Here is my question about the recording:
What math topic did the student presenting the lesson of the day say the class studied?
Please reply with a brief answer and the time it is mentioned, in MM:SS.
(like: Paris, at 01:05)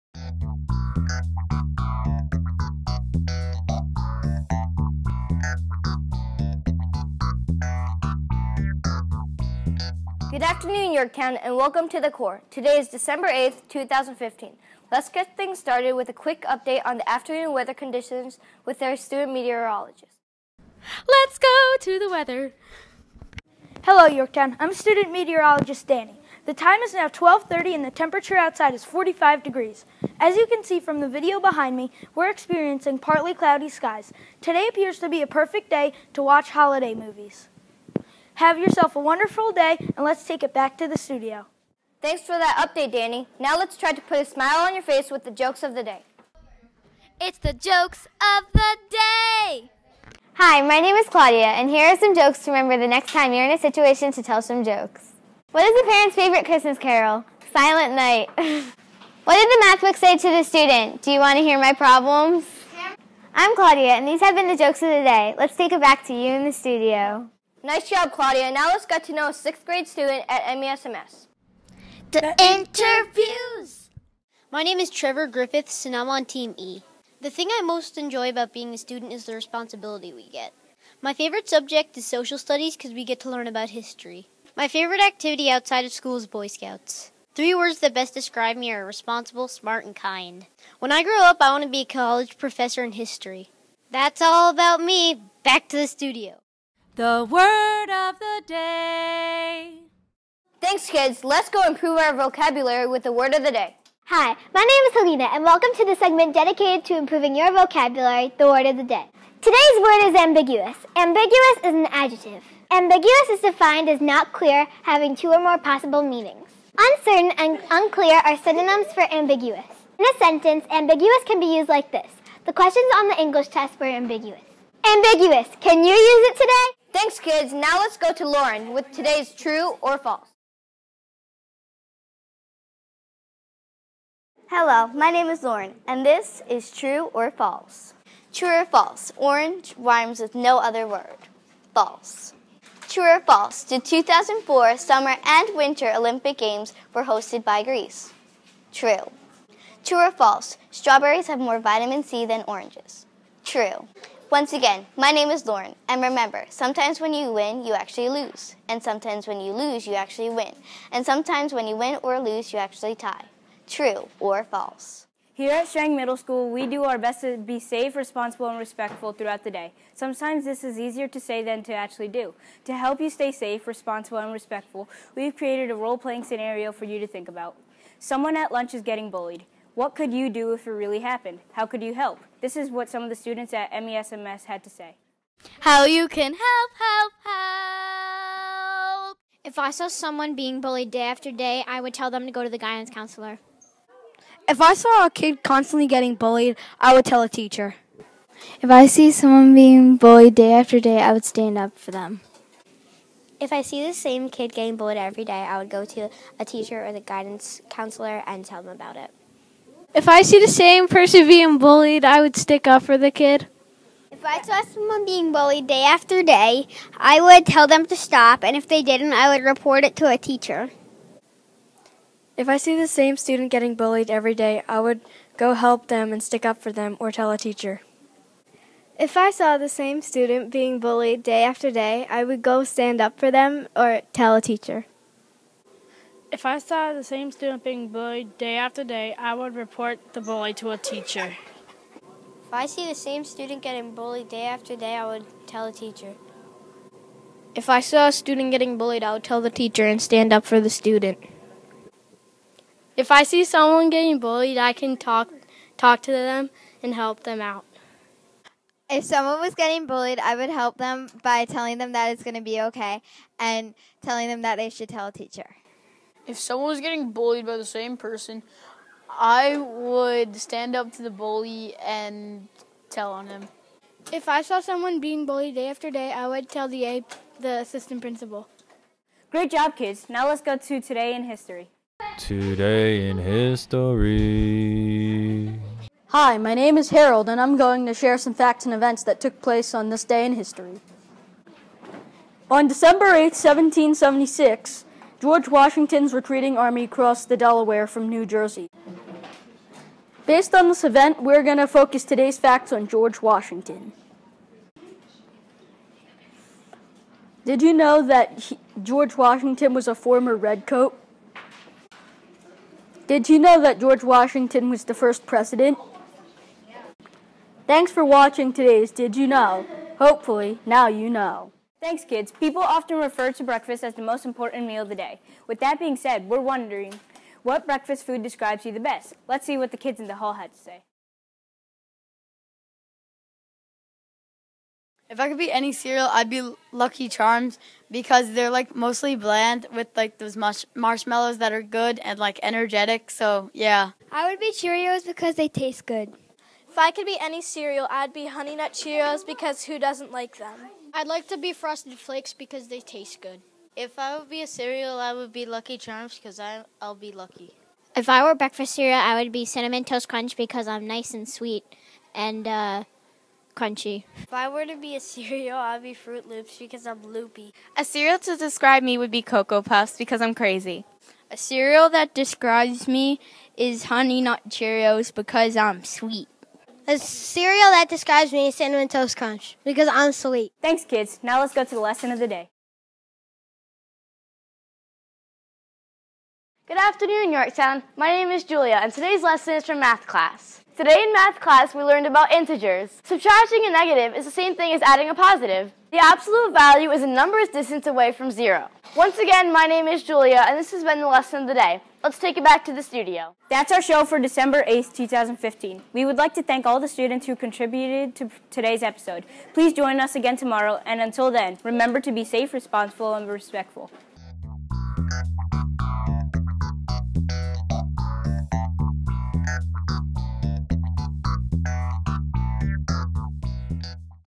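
integers, at 06:32.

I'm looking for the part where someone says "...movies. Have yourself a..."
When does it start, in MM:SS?
00:36.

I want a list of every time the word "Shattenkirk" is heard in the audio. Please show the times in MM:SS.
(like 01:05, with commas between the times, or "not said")
not said.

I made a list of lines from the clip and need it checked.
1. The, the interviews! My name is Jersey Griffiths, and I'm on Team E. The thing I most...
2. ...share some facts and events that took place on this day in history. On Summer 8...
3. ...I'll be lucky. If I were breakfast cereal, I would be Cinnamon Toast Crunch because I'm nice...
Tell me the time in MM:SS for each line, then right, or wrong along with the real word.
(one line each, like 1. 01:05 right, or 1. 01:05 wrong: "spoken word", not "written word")
1. 01:12 wrong: "Trevor", not "Jersey"
2. 04:47 wrong: "December", not "Summer"
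3. 05:56 right.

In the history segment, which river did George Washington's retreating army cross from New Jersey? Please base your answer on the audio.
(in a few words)
the Delaware.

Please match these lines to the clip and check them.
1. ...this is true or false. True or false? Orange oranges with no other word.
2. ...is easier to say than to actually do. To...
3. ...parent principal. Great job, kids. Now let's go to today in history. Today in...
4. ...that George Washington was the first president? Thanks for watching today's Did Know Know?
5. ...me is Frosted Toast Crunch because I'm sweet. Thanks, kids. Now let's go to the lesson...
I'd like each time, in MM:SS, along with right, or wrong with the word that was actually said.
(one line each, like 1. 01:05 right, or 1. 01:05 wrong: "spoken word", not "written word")
1. 02:16 wrong: "rhymes", not "oranges"
2. 02:50 right
3. 04:37 wrong: "assistant", not "parent"
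4. 05:13 wrong: "You", not "Know"
5. 06:18 wrong: "Cinnamon", not "Frosted".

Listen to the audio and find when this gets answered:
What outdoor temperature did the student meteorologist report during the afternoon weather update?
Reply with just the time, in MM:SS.
00:28.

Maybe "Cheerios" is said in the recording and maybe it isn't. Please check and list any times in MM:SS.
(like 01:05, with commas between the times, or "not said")
05:44, 05:48, 06:14.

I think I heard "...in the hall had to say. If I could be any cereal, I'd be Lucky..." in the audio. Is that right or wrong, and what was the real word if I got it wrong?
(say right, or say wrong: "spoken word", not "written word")
right.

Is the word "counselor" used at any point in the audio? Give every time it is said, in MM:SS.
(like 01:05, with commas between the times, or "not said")
03:12, 03:27.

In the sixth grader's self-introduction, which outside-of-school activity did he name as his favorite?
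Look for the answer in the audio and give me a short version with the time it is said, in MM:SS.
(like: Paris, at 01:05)
Boy Scouts, at 01:26.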